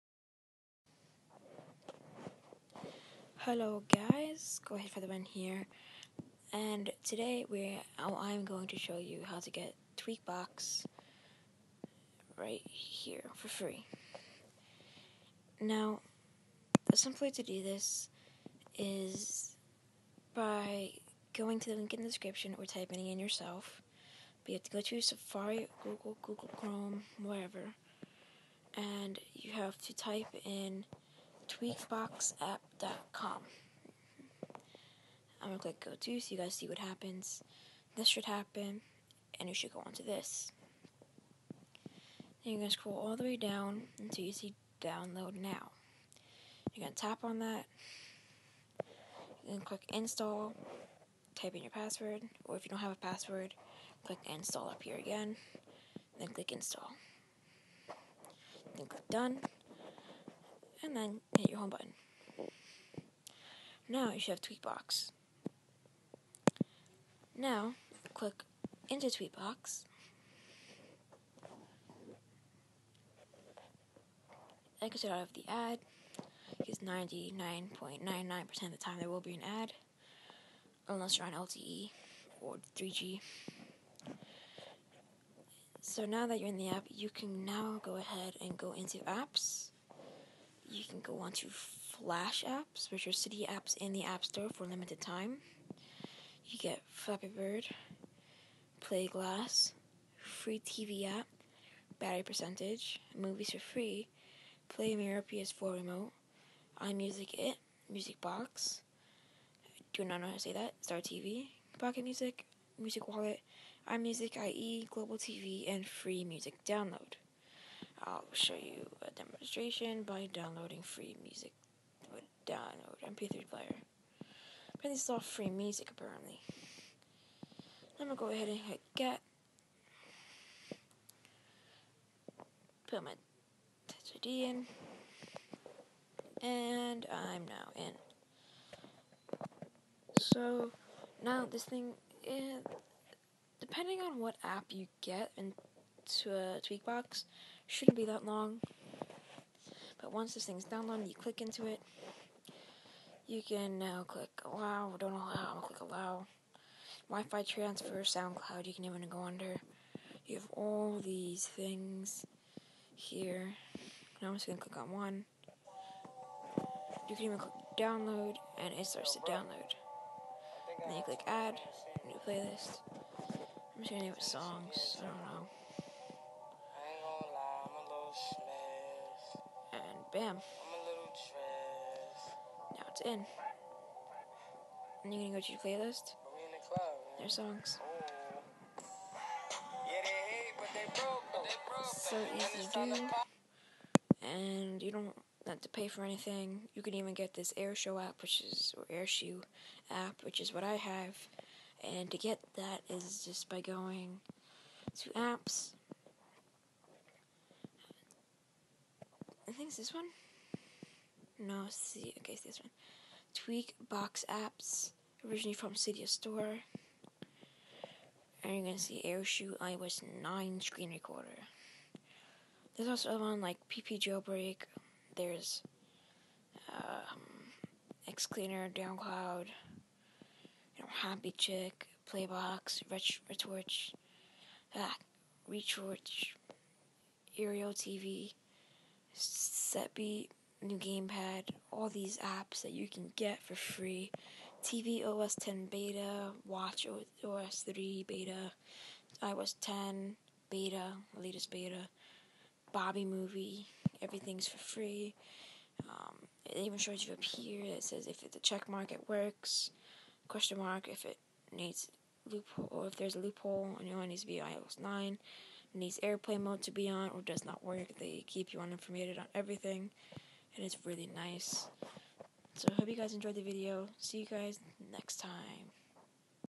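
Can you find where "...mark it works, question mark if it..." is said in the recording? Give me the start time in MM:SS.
04:18.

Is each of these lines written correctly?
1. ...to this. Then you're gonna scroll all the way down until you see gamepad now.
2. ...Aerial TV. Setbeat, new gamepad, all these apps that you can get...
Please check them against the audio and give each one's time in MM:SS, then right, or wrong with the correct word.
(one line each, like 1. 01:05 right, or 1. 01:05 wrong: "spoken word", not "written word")
1. 00:39 wrong: "download", not "gamepad"
2. 03:57 right.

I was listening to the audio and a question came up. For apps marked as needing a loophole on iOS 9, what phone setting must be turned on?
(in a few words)
airplane mode.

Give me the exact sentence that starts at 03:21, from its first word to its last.
And to get that is just by going to apps, think it's this one.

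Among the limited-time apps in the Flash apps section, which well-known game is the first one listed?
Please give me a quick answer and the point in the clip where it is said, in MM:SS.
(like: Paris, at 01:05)
Flappy Bird, at 01:36.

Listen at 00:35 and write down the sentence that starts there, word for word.
I'm gonna click go to so you guys see what happens.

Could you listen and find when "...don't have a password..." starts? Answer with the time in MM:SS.
00:52.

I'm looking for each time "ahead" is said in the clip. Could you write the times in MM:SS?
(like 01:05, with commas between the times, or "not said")
00:04, 01:27, 02:08.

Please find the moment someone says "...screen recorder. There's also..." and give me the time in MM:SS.
03:40.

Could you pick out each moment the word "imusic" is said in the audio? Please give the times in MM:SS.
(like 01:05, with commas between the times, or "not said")
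01:46, 01:53.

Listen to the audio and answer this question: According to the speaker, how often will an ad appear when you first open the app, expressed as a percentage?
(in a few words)
99.99%.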